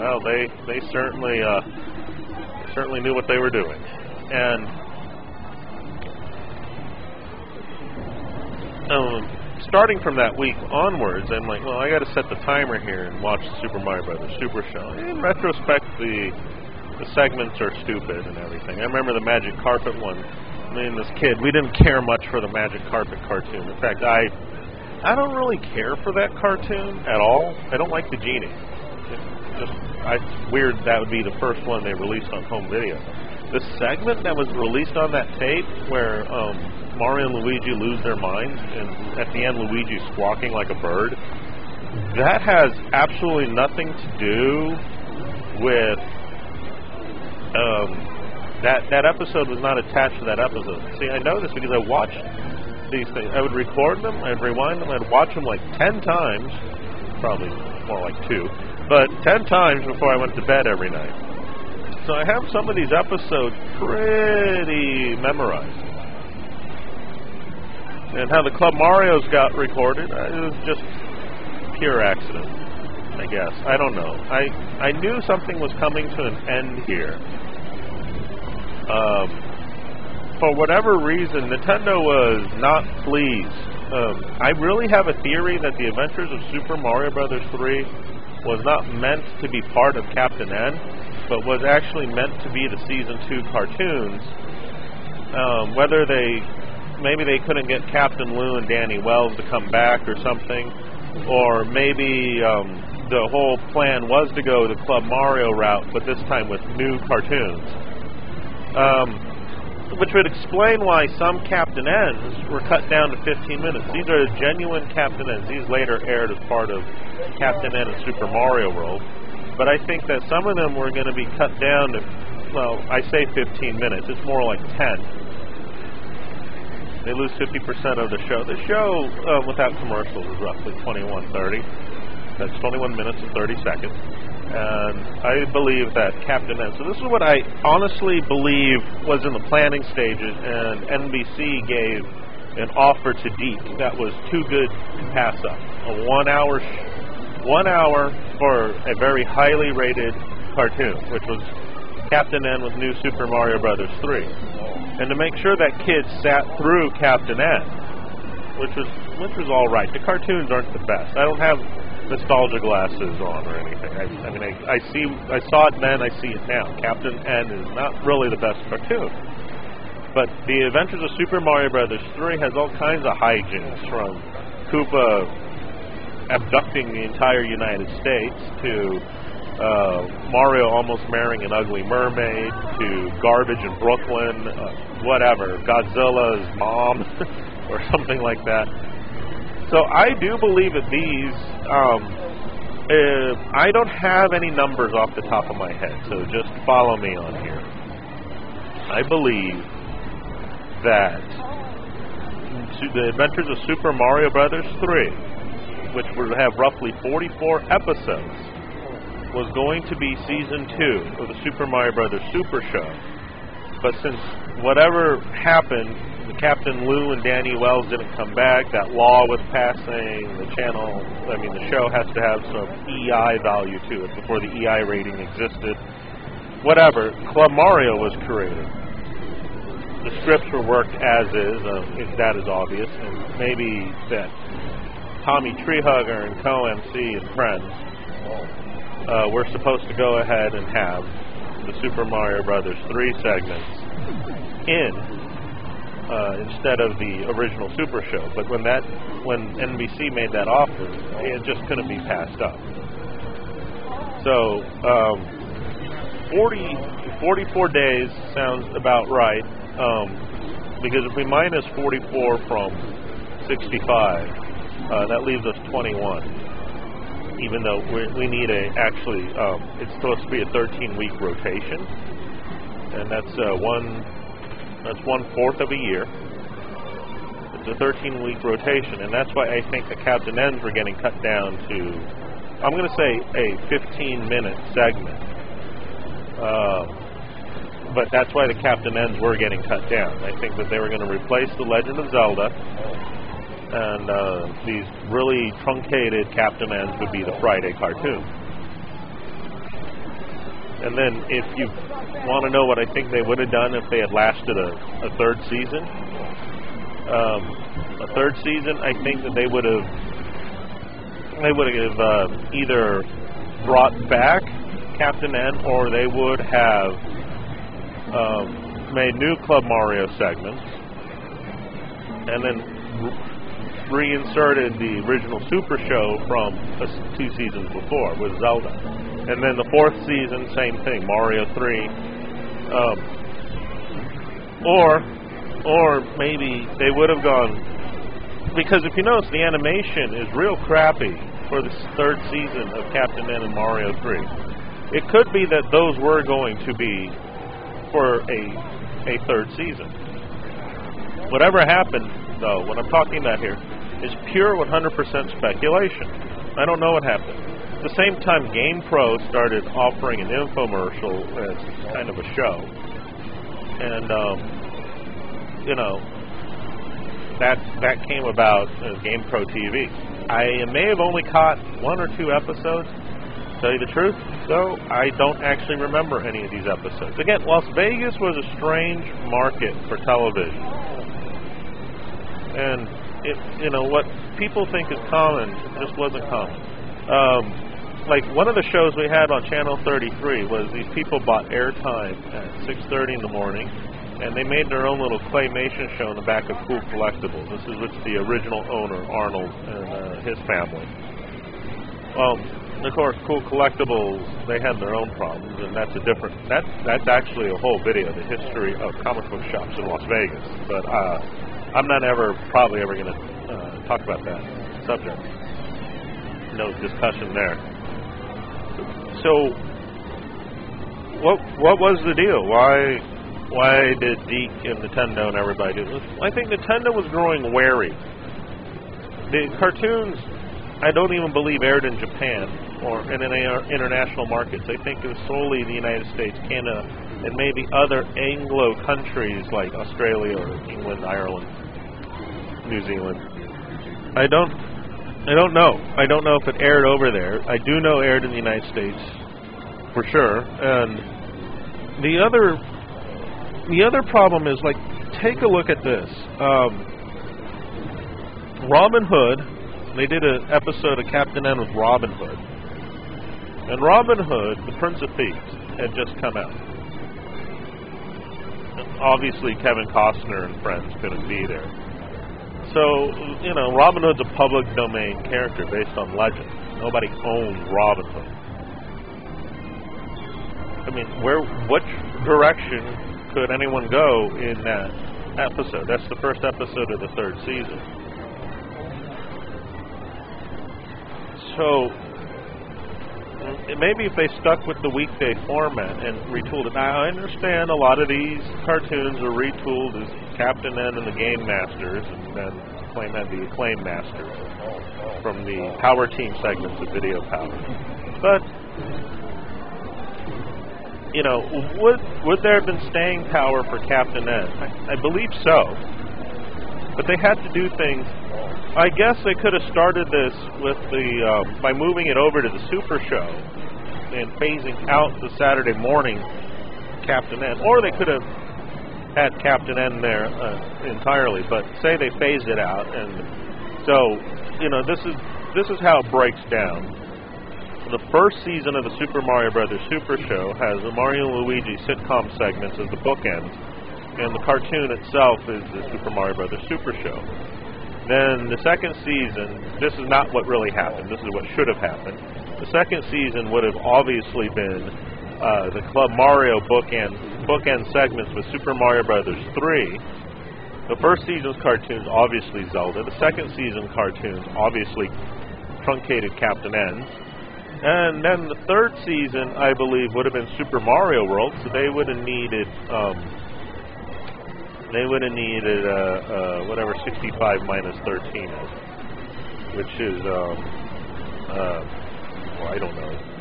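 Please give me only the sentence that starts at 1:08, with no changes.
And how the Club Mario's got recorded, uh, it was just pure accident, I guess.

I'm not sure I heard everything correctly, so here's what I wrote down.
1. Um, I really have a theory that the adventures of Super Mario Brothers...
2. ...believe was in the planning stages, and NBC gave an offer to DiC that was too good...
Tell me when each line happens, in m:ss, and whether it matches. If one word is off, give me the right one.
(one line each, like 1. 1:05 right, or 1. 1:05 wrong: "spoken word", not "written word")
1. 1:23 right
2. 2:18 right.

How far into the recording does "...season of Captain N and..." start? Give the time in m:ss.
5:42.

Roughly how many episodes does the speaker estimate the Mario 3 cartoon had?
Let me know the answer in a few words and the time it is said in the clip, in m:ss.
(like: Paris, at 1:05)
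44, at 3:27.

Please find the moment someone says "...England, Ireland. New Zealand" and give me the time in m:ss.
7:20.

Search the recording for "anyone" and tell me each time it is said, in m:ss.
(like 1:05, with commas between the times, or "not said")
8:03.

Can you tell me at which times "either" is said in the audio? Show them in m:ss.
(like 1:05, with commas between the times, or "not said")
5:12.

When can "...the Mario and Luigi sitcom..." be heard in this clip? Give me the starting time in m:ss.
9:00.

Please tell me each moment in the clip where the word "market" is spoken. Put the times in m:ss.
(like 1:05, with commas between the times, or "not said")
6:19, 7:14.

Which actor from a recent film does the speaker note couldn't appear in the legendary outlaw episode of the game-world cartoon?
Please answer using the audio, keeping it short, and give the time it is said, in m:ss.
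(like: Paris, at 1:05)
Kevin Costner, at 7:49.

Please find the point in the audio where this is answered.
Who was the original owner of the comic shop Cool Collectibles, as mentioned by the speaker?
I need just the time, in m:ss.
6:39.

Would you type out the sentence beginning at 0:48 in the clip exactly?
That episode was not attached to that episode.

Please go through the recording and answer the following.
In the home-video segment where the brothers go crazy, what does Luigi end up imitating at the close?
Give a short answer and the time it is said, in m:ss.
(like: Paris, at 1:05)
A bird, at 0:40.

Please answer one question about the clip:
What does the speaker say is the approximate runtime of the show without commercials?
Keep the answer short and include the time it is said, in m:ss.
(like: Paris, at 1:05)
21:30, at 2:10.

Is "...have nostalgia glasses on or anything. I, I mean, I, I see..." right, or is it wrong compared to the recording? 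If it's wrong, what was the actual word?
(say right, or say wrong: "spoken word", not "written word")
right.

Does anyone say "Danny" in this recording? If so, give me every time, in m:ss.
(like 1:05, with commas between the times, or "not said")
1:38, 3:37.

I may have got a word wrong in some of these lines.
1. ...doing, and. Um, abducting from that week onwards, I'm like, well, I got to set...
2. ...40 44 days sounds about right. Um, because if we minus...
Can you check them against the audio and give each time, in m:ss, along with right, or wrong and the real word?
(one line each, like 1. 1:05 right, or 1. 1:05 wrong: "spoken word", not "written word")
1. 0:03 wrong: "starting", not "abducting"
2. 4:16 right.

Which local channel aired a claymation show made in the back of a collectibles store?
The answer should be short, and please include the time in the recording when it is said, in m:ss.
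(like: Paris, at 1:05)
Channel 33, at 6:29.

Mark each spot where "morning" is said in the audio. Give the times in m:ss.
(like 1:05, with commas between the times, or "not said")
6:33, 8:45.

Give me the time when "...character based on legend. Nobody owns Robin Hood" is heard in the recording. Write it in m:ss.
7:55.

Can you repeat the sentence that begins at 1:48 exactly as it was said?
Um, which would explain why some Captain N's were cut down to 15 minutes.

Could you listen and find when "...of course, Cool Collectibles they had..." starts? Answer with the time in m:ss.
6:42.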